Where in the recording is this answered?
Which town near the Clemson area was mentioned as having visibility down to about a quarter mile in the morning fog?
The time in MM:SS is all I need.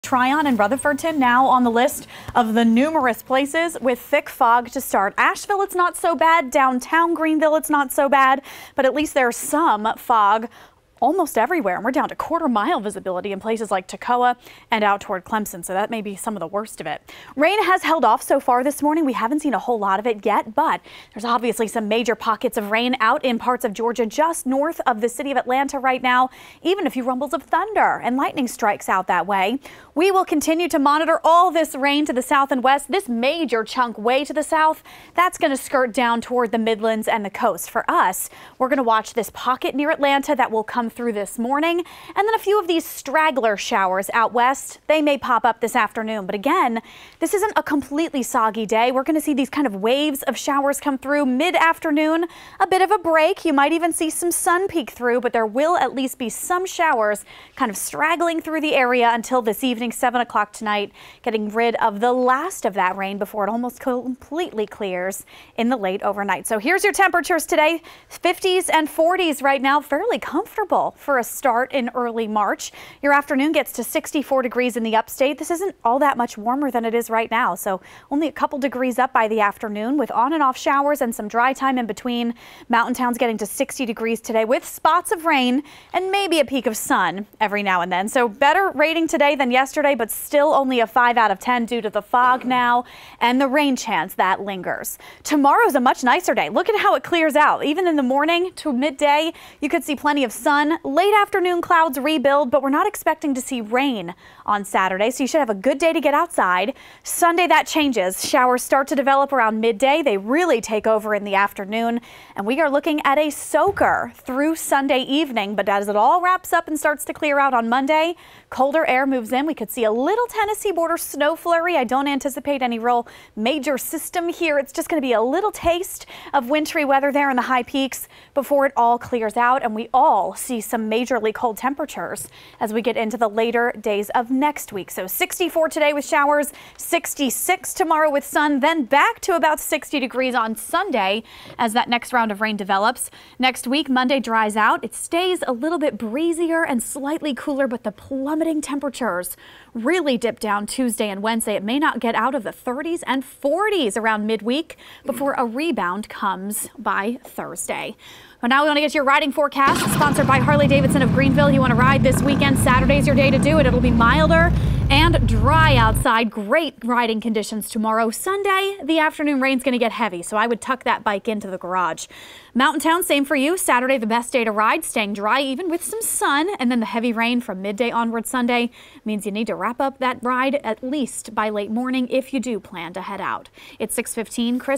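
00:13.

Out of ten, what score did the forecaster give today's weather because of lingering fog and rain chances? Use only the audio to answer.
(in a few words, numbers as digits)
5.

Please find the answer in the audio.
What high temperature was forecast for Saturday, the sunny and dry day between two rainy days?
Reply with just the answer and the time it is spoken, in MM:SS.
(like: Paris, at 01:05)
66, at 02:16.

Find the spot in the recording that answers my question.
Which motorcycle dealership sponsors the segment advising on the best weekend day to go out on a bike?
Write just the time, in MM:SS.
02:40.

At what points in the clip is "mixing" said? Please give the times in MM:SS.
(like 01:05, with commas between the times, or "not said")
not said.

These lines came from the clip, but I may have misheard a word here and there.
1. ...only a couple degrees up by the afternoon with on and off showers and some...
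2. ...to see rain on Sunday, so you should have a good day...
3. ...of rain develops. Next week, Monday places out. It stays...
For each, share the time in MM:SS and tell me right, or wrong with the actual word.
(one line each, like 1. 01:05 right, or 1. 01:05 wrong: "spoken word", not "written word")
1. 01:18 right
2. 01:43 wrong: "Saturday", not "Sunday"
3. 02:22 wrong: "dries", not "places".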